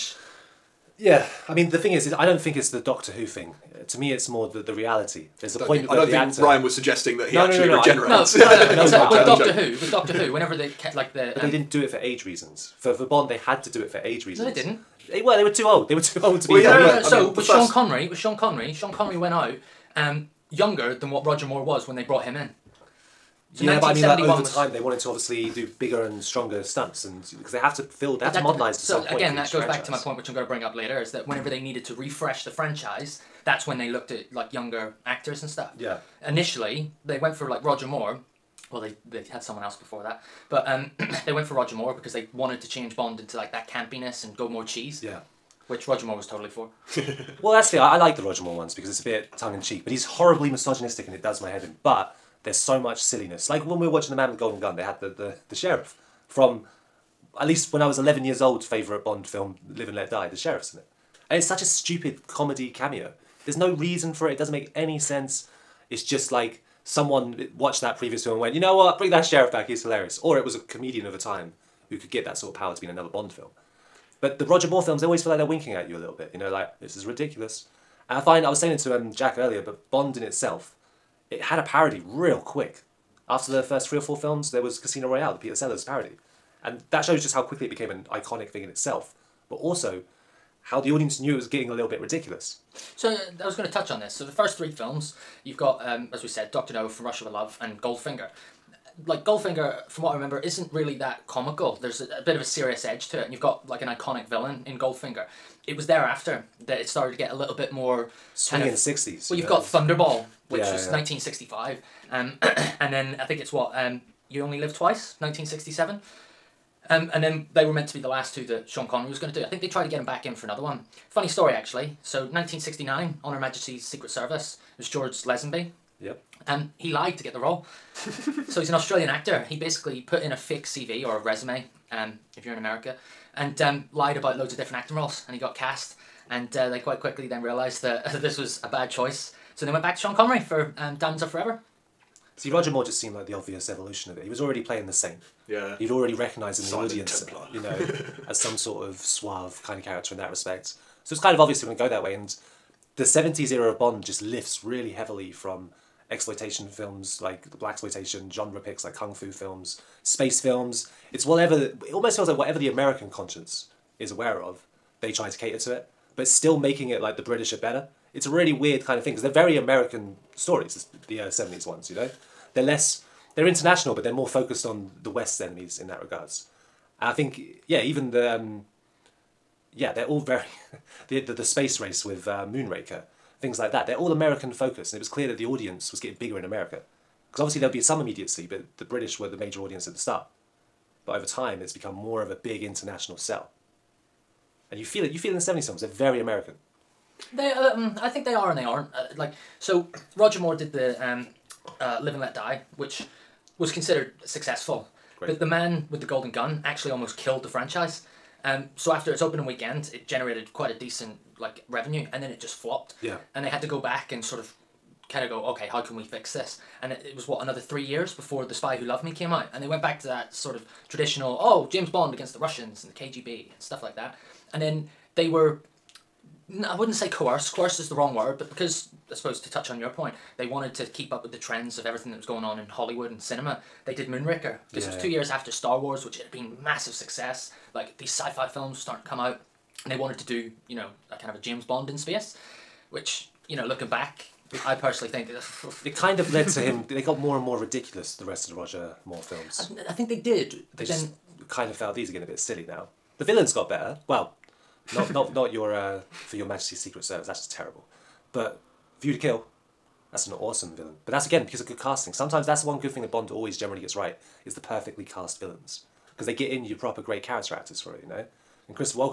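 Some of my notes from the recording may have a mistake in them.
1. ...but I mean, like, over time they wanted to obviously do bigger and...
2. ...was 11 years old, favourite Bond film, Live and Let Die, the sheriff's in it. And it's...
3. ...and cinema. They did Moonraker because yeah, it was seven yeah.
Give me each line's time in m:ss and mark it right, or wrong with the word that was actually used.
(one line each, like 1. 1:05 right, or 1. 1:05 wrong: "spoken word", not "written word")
1. 0:23 right
2. 0:57 right
3. 3:53 wrong: "two", not "seven".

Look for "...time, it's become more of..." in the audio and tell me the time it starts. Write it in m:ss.
3:11.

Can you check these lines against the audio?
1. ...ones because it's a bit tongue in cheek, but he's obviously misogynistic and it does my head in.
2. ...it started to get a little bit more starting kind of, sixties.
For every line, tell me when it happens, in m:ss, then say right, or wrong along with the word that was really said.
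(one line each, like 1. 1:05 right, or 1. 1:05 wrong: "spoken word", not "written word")
1. 0:48 wrong: "horribly", not "obviously"
2. 1:46 wrong: "swinging", not "starting".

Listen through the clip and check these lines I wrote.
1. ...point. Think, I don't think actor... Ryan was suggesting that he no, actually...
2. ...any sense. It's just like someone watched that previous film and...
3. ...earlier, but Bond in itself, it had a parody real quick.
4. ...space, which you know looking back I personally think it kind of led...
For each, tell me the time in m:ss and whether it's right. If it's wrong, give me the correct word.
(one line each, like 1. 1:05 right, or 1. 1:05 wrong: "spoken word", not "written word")
1. 0:05 right
2. 1:04 right
3. 1:19 right
4. 4:01 right.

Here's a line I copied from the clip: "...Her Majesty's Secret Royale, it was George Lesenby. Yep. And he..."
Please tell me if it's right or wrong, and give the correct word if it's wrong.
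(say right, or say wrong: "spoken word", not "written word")
wrong: "Service", not "Royale".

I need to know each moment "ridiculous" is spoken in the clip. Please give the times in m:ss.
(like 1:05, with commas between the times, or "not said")
1:17, 1:31, 4:07.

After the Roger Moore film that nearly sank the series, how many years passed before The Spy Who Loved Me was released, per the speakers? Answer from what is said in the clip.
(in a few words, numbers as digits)
3.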